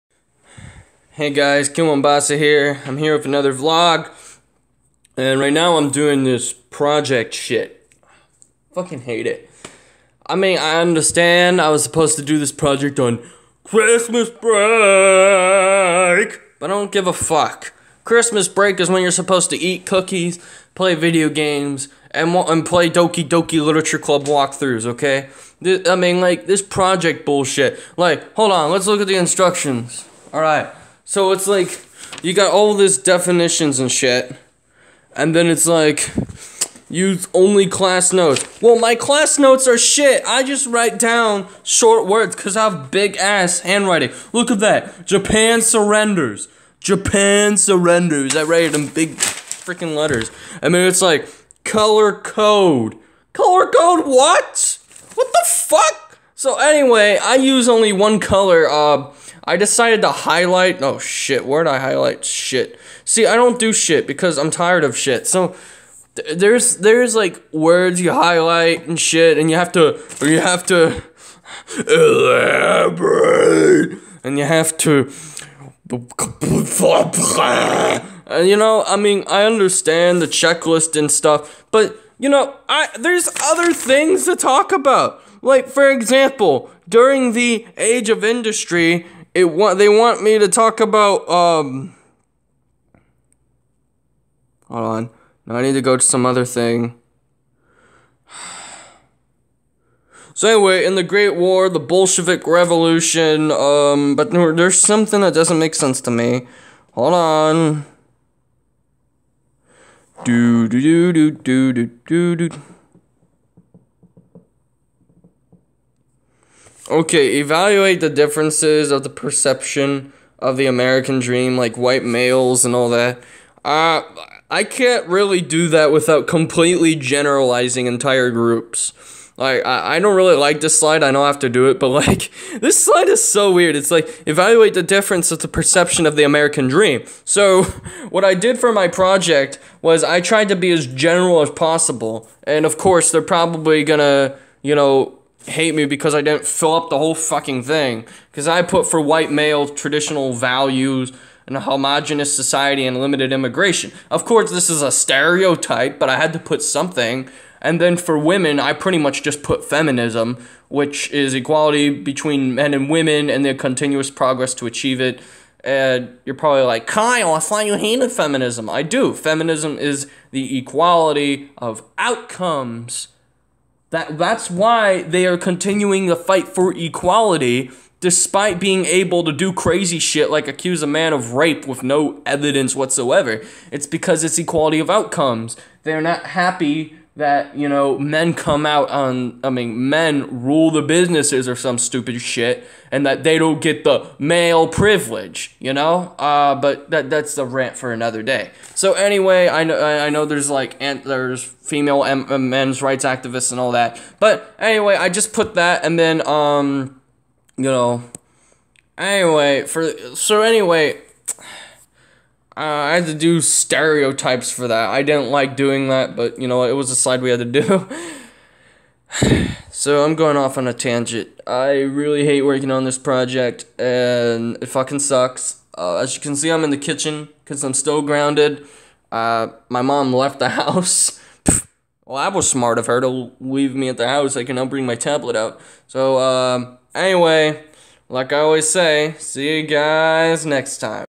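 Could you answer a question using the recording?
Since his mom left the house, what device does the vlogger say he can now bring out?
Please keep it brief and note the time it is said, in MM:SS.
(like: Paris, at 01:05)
tablet, at 03:54.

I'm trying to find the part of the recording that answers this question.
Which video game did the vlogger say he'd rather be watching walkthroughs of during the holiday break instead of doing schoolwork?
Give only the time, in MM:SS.
00:22.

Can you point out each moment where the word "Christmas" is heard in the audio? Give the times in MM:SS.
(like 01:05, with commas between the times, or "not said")
00:13, 00:18.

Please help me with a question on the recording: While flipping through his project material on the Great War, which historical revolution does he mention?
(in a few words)
Bolshevik Revolution.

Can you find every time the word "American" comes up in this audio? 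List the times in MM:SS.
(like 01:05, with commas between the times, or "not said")
02:00, 02:16.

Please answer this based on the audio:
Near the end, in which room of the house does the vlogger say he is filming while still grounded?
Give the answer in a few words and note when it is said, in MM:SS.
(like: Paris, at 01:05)
kitchen, at 03:46.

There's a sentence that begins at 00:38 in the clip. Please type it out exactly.
Well, my class notes are shit.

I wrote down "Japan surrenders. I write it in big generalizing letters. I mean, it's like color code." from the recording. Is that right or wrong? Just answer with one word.
wrong.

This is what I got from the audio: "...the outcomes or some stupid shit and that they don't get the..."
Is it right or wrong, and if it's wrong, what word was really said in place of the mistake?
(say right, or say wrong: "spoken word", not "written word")
wrong: "businesses", not "outcomes".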